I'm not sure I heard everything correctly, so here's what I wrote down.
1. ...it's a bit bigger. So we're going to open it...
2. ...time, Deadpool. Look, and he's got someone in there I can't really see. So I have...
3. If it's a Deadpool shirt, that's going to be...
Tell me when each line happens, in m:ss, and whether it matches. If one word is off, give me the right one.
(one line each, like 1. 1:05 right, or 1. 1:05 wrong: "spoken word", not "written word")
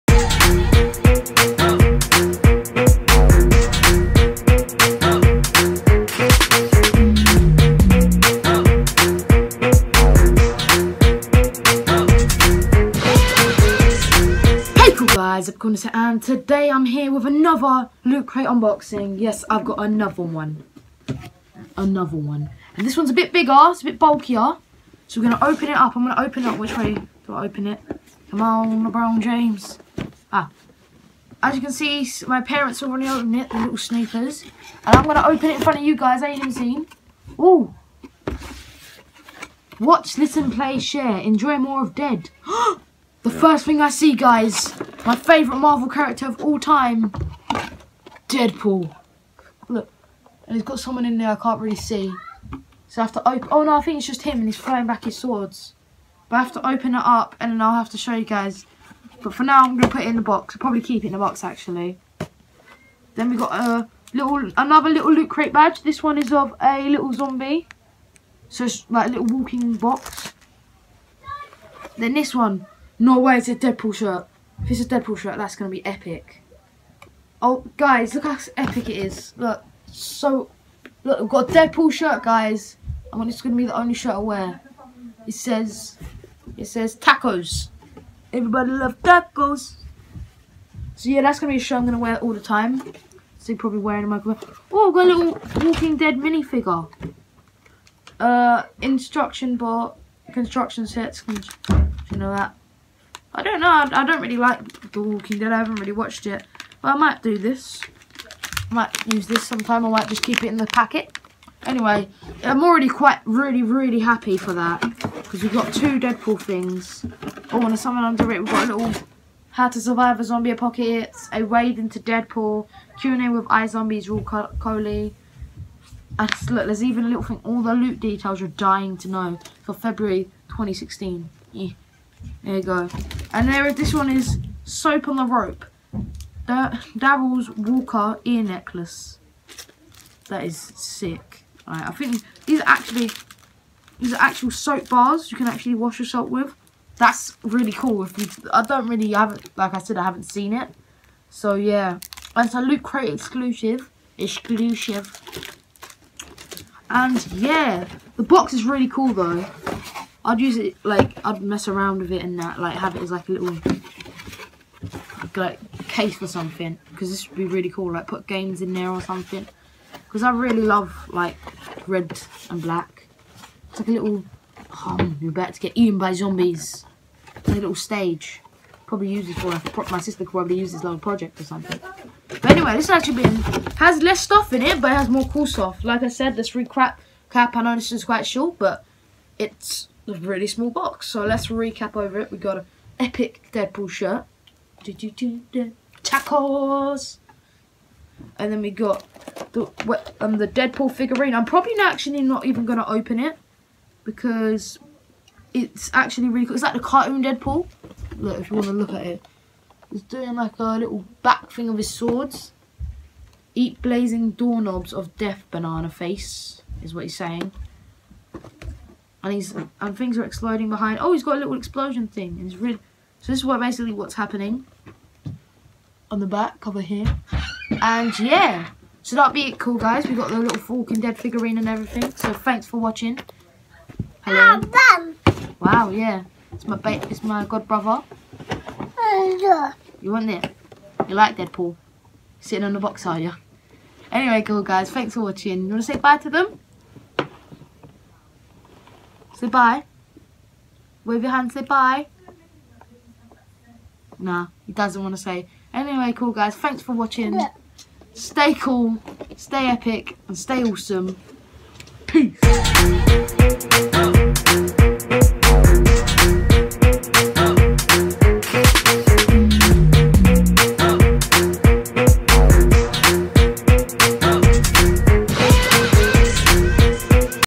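1. 0:23 wrong: "bulkier", not "bigger"
2. 0:46 right
3. 1:14 right.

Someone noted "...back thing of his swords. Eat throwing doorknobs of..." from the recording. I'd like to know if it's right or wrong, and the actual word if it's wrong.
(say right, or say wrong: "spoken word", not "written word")
wrong: "blazing", not "throwing".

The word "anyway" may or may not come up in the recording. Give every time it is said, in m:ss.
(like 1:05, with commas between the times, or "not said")
1:51, 3:02, 4:04, 4:15.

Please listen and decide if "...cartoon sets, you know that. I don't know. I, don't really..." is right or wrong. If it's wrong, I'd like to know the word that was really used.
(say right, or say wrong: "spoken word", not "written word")
wrong: "construction", not "cartoon".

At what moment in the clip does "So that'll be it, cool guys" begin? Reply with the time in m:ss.
3:49.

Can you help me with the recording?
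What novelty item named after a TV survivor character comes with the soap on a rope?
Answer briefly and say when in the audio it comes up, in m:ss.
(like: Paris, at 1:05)
Daryl's Walker ear necklace, at 2:16.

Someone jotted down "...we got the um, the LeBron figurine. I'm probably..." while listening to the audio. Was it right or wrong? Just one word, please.
wrong.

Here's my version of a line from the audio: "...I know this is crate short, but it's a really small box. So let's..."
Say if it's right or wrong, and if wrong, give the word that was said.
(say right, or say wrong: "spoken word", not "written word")
wrong: "quite", not "crate".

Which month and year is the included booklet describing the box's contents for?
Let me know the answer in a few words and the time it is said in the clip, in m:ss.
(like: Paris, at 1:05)
February 2016, at 2:09.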